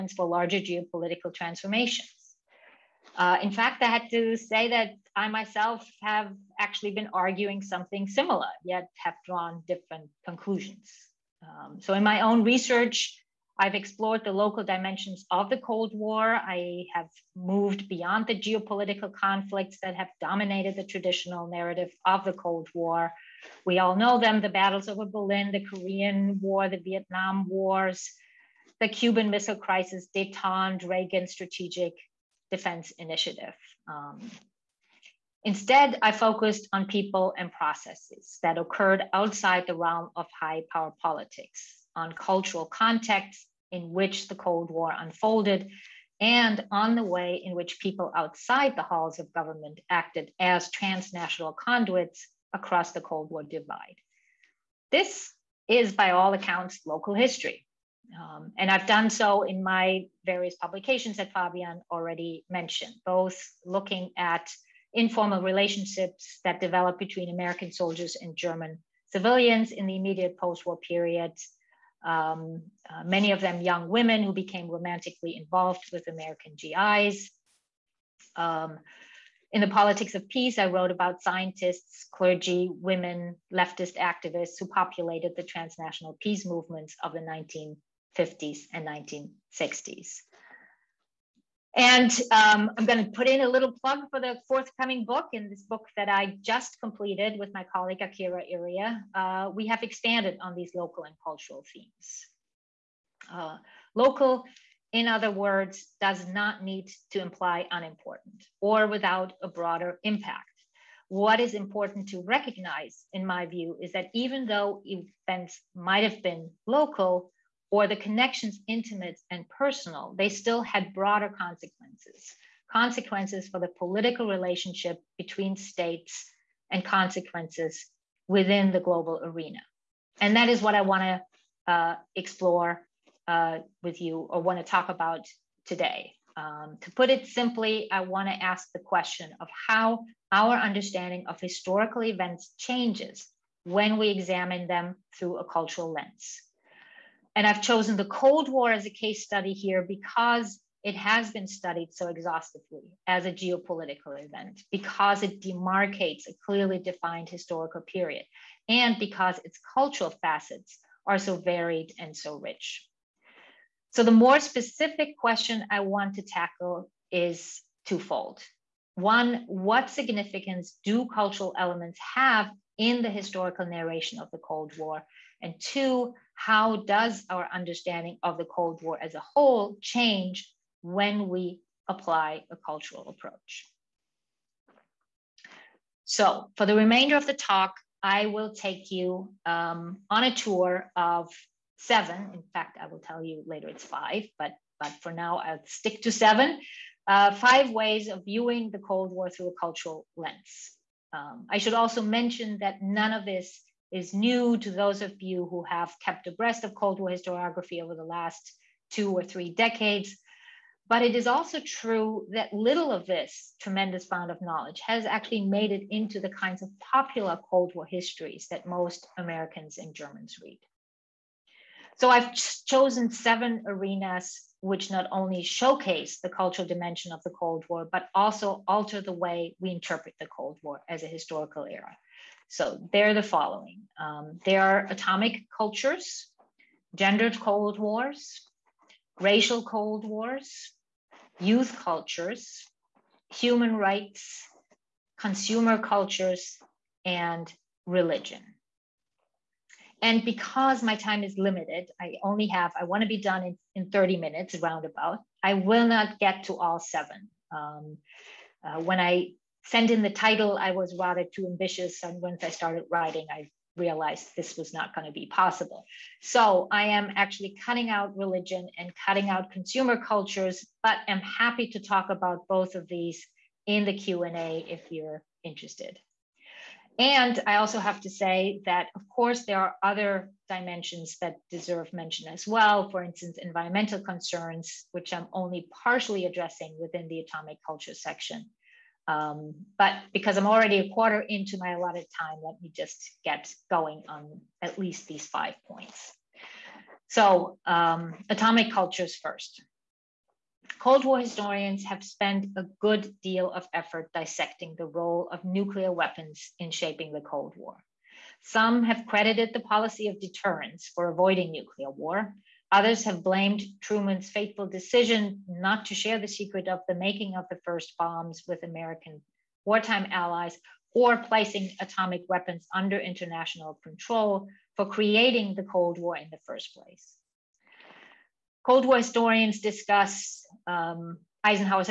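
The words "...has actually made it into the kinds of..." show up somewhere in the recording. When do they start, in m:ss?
3:34.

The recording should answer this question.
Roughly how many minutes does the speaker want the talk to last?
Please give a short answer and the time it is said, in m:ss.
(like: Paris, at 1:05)
30, at 4:13.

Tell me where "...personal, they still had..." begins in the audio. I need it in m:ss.
1:59.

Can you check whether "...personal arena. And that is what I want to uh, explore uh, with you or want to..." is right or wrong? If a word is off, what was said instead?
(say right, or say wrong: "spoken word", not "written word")
wrong: "global", not "personal".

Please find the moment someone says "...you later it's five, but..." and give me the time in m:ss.
3:13.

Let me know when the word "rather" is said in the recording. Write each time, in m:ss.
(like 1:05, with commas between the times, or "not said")
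4:20.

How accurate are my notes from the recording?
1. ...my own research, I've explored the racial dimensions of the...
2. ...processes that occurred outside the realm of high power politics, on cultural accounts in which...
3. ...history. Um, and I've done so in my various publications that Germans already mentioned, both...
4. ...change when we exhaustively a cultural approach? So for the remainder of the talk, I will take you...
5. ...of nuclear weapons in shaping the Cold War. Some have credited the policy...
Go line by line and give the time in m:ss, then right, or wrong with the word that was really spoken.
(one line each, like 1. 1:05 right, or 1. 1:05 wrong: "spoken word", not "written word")
1. 0:12 wrong: "local", not "racial"
2. 0:37 wrong: "contexts", not "accounts"
3. 0:57 wrong: "Fabian", not "Germans"
4. 2:59 wrong: "apply", not "exhaustively"
5. 5:05 right.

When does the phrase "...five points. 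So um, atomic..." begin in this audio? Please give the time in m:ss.
4:55.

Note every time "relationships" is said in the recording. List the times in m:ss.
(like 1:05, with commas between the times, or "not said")
1:05, 2:04.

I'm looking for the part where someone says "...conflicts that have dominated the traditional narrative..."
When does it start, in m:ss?
0:19.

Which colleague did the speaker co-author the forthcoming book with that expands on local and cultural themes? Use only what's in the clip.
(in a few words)
Akira Iriye.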